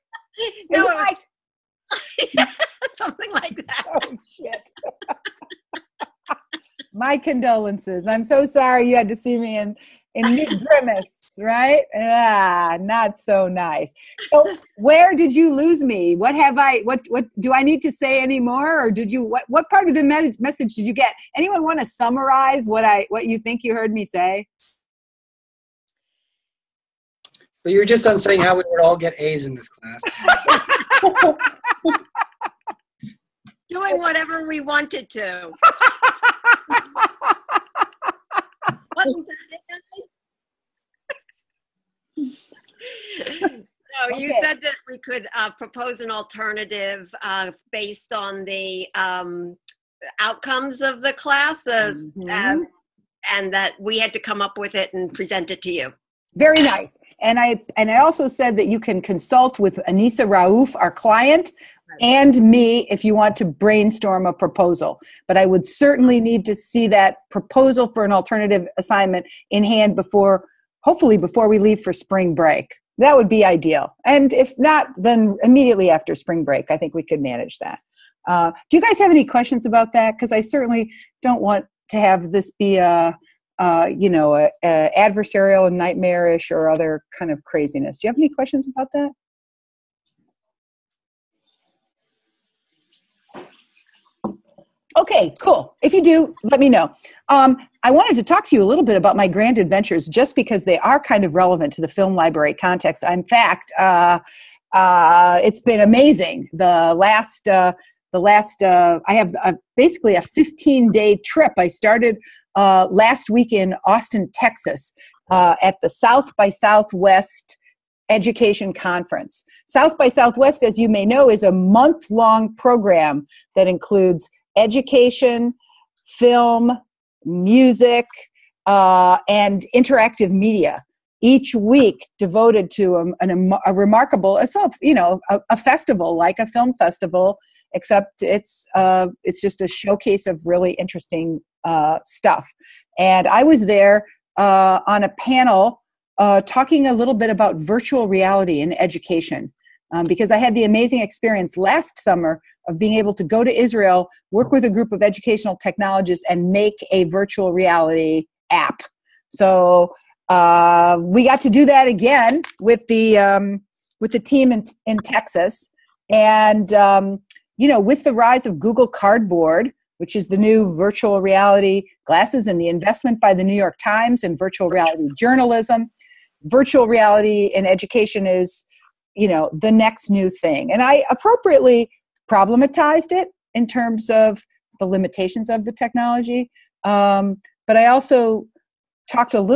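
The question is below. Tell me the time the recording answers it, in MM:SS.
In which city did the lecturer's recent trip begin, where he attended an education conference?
01:53.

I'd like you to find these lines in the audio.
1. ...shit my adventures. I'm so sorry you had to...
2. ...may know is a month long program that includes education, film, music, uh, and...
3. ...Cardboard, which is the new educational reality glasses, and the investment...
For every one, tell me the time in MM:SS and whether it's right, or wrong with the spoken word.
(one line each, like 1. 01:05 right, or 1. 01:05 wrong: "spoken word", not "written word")
1. 00:04 wrong: "condolences", not "adventures"
2. 02:00 right
3. 02:48 wrong: "virtual", not "educational".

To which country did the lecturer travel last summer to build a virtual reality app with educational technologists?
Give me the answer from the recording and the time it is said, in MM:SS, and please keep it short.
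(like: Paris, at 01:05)
Israel, at 02:33.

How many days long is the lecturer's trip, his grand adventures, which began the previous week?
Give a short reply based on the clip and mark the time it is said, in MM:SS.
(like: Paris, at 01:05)
15, at 01:50.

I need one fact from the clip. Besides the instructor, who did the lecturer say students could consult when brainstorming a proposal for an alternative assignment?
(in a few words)
Anisa Rauf.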